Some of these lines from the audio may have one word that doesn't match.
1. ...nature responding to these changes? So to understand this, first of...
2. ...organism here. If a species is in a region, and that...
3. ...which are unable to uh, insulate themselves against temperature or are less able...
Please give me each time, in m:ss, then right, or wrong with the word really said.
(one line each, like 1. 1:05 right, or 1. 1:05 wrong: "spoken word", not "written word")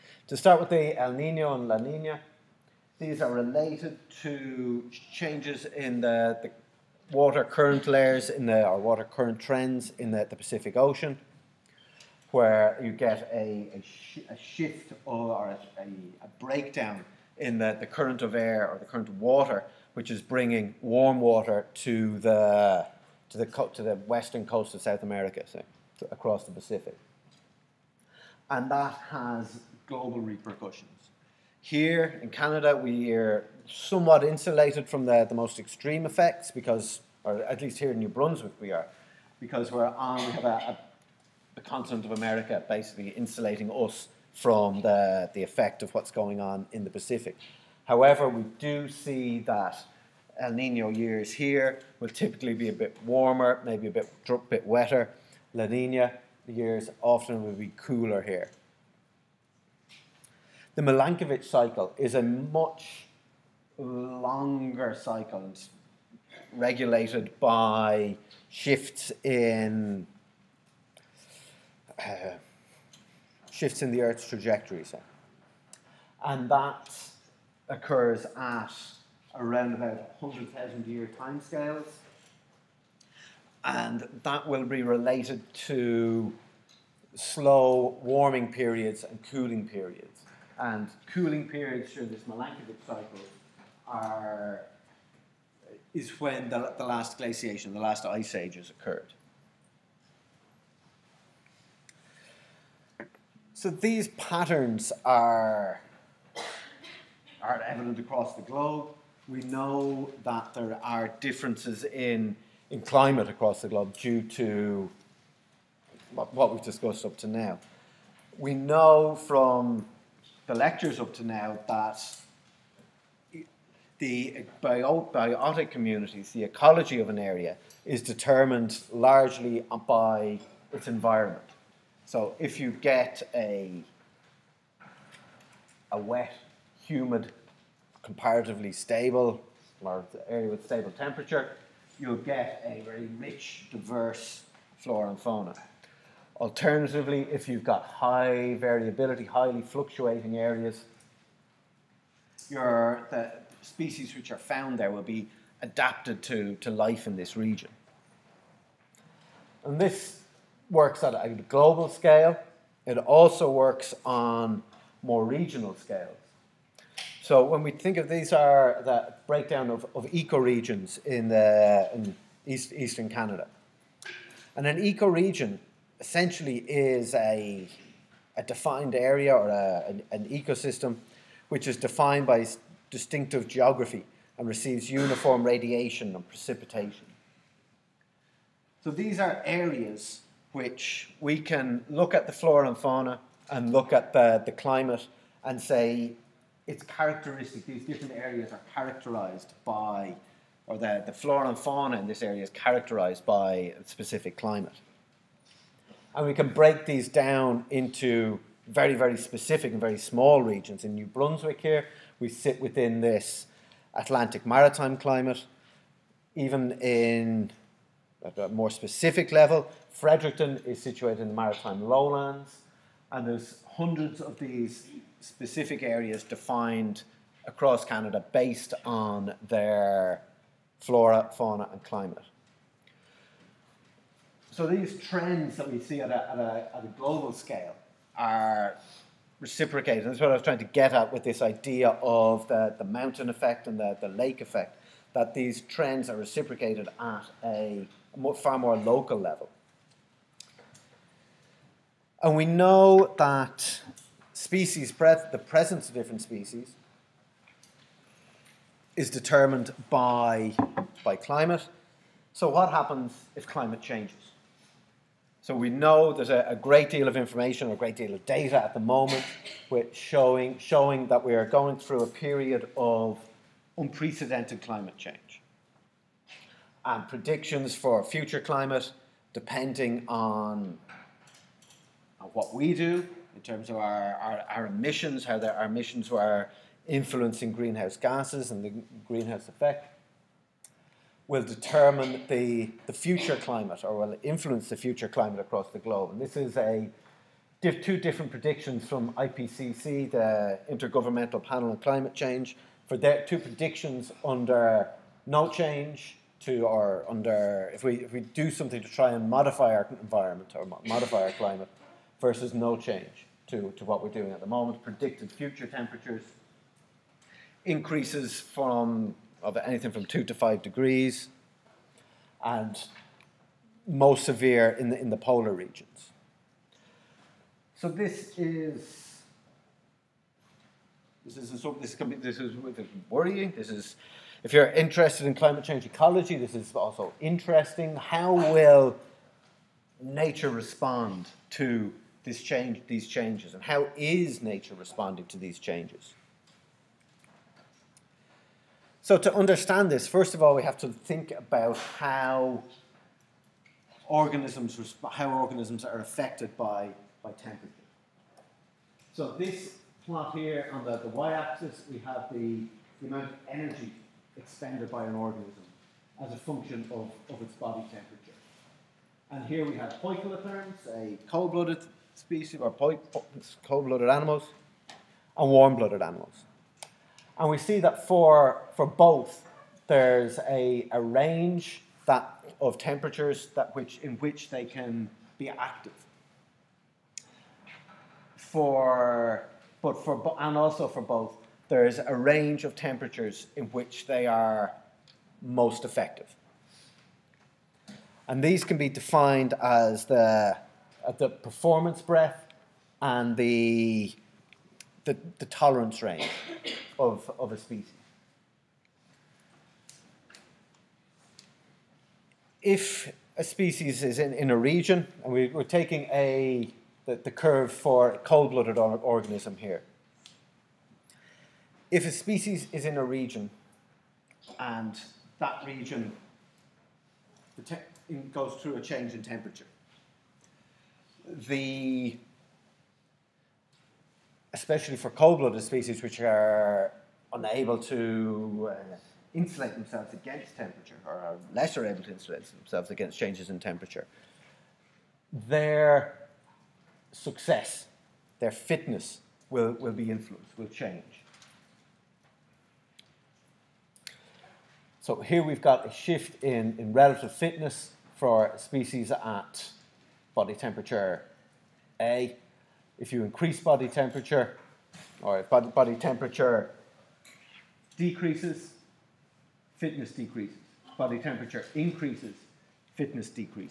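1. 5:44 right
2. 6:58 right
3. 7:16 right.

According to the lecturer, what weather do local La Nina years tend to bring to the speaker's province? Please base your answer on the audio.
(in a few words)
Cooler.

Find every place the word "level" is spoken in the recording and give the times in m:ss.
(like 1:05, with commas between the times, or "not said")
3:39, 4:09.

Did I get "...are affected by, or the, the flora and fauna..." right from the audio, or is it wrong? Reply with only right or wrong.
wrong.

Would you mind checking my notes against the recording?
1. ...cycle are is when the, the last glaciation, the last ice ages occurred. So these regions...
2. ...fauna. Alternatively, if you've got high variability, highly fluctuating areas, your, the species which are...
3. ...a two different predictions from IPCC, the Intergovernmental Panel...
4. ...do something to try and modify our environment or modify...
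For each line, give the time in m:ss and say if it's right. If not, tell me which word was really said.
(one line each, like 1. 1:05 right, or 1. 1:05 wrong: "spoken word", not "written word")
1. 1:32 wrong: "patterns", not "regions"
2. 2:25 right
3. 4:56 right
4. 5:08 right.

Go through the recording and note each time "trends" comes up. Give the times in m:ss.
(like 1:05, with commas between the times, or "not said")
0:09, 3:55, 4:05.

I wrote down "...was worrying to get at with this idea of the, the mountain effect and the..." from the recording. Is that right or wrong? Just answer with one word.
wrong.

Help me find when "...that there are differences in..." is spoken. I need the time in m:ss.
1:50.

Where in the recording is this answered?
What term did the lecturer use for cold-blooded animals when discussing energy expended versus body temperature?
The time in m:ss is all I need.
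6:10.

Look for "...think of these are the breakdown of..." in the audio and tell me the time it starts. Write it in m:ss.
2:47.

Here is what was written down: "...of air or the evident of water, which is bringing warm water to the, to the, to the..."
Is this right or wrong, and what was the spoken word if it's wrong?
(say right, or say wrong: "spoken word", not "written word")
wrong: "current", not "evident".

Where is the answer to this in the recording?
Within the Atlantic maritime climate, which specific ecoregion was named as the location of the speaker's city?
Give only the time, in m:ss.
3:41.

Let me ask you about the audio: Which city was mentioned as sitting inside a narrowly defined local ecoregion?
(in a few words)
Fredericton.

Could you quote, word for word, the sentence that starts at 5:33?
This is if you're interested in climate change ecology, this is also interesting.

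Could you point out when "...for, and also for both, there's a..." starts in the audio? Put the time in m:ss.
6:30.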